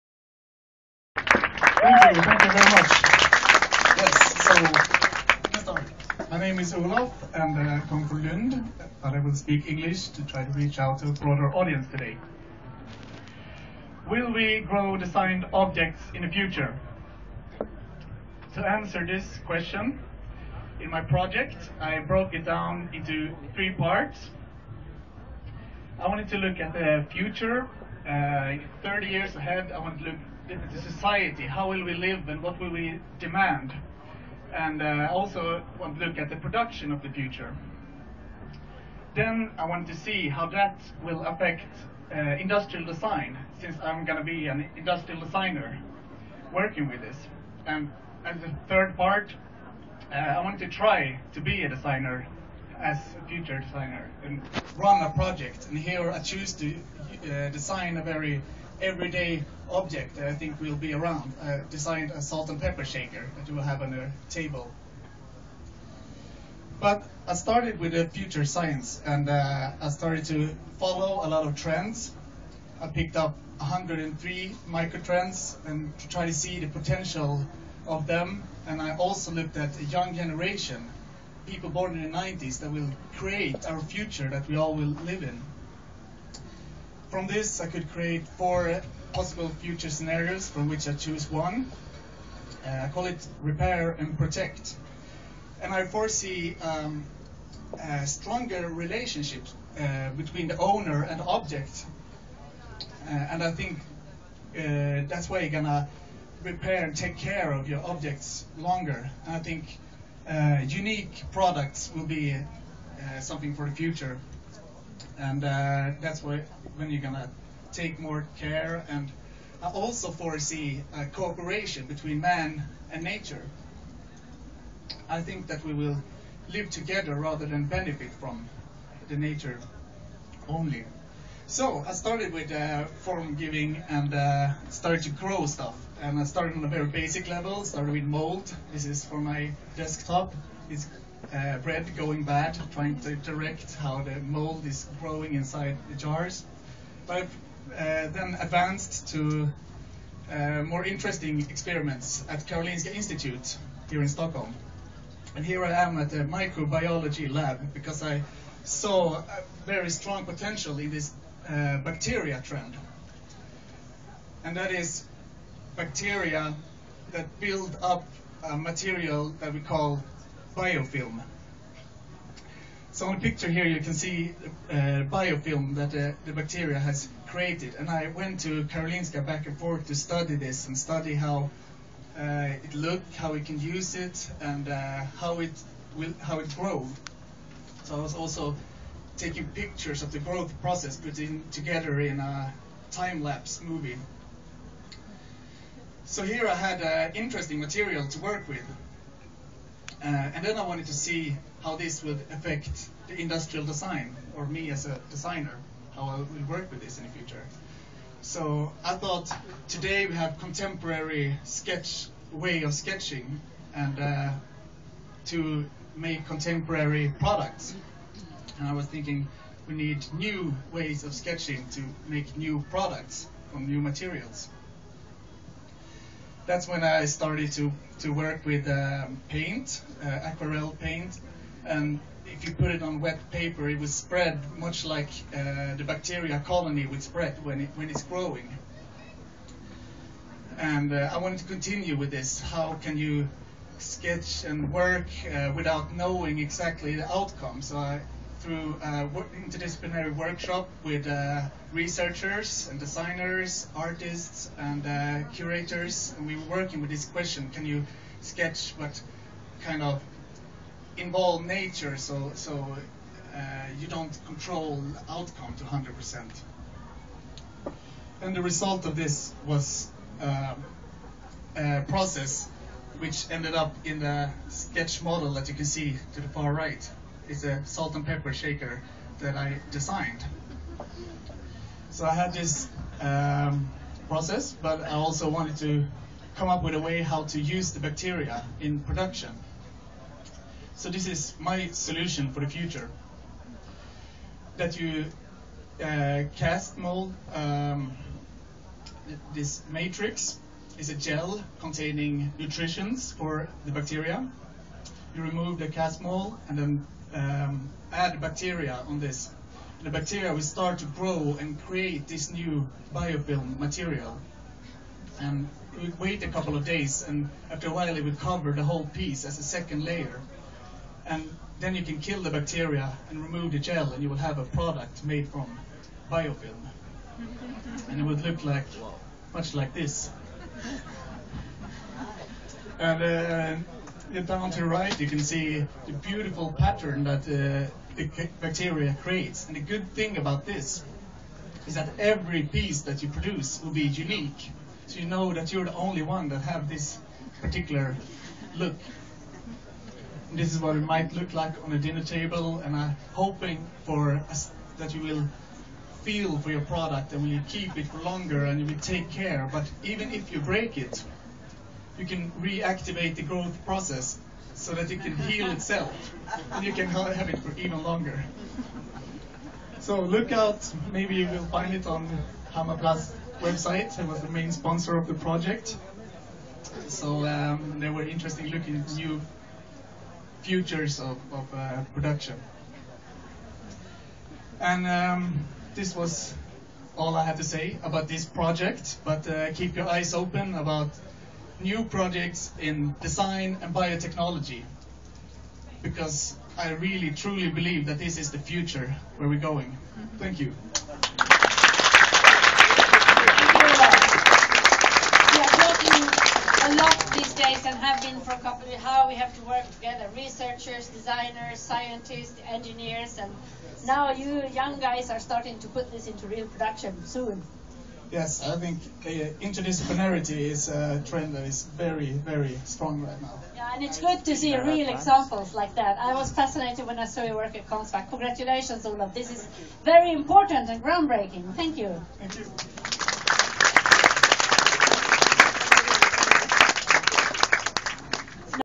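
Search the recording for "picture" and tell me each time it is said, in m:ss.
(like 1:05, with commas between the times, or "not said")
2:53, 3:09.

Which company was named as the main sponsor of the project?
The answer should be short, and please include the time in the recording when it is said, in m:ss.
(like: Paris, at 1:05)
Hammarplast, at 6:12.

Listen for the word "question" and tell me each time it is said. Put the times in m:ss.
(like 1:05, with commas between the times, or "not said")
0:19, 4:17.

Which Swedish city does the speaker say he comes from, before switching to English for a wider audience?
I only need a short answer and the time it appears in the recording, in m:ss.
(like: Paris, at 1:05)
Lund, at 0:08.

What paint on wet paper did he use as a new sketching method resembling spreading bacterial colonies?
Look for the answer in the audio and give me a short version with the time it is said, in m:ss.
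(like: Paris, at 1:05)
Aquarel paint, at 3:50.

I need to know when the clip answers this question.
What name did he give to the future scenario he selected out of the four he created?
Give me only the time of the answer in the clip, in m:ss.
1:33.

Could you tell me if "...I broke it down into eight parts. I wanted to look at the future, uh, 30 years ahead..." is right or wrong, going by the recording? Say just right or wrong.
wrong.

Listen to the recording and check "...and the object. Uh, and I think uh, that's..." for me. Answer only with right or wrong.
right.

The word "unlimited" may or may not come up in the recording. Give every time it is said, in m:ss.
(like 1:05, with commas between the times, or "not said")
not said.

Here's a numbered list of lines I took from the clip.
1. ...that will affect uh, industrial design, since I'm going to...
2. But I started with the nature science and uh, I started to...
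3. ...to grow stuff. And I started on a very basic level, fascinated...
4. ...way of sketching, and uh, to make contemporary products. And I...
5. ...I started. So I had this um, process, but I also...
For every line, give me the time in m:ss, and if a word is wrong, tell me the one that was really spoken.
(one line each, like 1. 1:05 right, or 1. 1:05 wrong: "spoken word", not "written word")
1. 0:40 right
2. 1:06 wrong: "future", not "nature"
3. 2:15 wrong: "started", not "fascinated"
4. 3:32 right
5. 4:39 wrong: "designed", not "started".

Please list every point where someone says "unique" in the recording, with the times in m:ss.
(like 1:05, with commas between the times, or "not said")
1:50, 5:43.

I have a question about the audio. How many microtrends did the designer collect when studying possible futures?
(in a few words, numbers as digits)
103.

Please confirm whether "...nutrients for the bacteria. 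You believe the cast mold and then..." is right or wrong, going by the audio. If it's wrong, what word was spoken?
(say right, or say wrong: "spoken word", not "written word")
wrong: "remove", not "believe".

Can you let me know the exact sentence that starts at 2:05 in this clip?
I think that we will live together rather than benefit from the nature only.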